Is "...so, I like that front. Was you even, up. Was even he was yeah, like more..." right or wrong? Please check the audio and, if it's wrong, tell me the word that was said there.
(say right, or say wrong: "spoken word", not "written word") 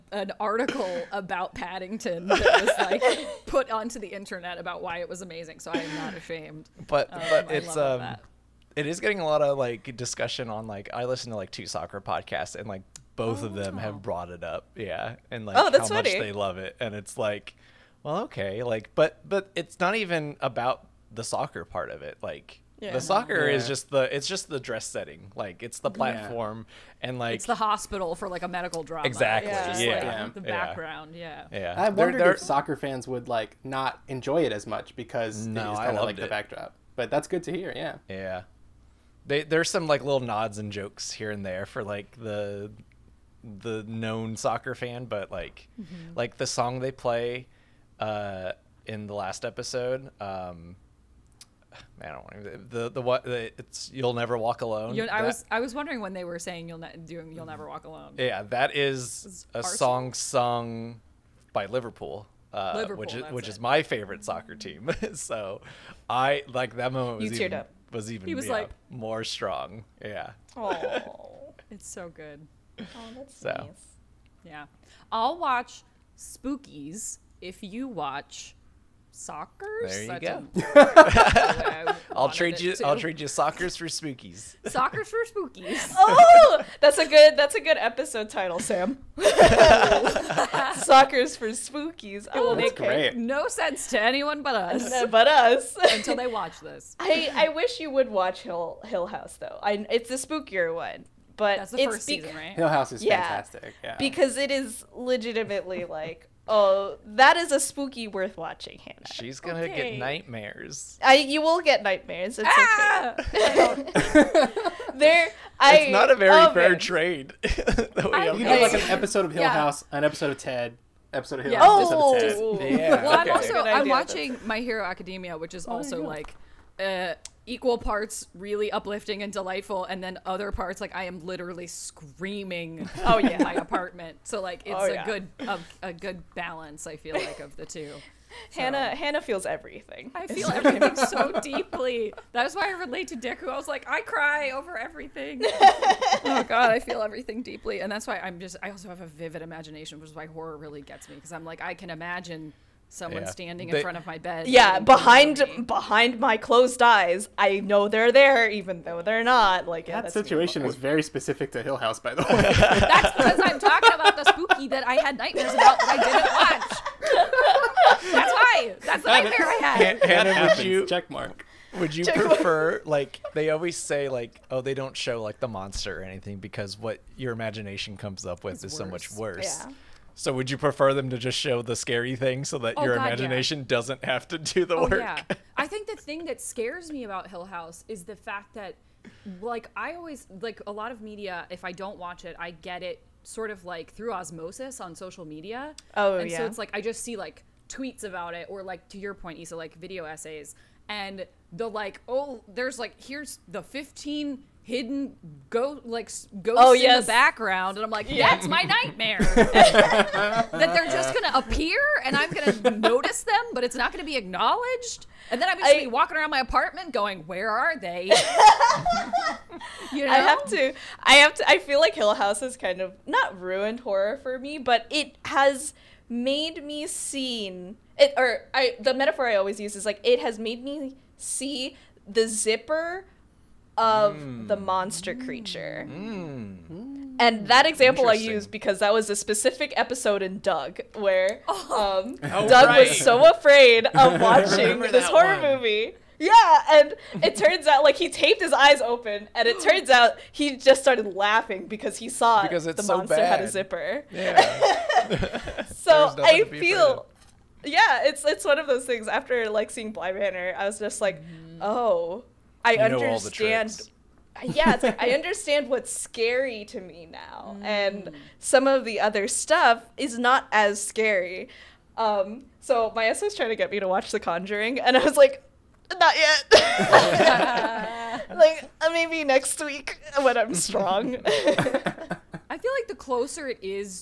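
wrong: "moment", not "front".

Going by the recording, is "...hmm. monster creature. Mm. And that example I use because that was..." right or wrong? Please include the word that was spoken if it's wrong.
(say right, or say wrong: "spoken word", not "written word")
right.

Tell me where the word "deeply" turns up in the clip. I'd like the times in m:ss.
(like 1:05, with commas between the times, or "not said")
2:21, 2:27.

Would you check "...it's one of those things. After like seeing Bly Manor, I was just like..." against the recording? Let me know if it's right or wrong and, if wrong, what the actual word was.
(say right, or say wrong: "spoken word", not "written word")
right.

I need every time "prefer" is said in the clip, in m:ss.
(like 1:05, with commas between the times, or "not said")
2:52, 3:00.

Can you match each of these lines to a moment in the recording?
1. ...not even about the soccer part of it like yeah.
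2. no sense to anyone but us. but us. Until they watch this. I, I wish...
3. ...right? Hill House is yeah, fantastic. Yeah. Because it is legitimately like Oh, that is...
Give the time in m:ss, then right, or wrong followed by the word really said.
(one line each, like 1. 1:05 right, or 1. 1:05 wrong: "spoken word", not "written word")
1. 0:19 right
2. 1:33 right
3. 1:42 right.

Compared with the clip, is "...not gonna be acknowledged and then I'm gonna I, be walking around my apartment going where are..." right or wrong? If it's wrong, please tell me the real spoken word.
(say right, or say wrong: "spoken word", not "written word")
right.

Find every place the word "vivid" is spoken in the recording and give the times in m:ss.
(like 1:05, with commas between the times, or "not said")
2:29.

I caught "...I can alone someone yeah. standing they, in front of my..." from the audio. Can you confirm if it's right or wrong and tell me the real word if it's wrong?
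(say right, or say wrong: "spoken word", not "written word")
wrong: "imagine", not "alone".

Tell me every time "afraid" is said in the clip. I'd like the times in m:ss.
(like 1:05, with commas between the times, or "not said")
4:03.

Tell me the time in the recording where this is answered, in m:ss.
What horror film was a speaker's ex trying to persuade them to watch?
4:34.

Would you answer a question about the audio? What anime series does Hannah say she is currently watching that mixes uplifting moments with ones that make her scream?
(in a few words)
My Hero Academia.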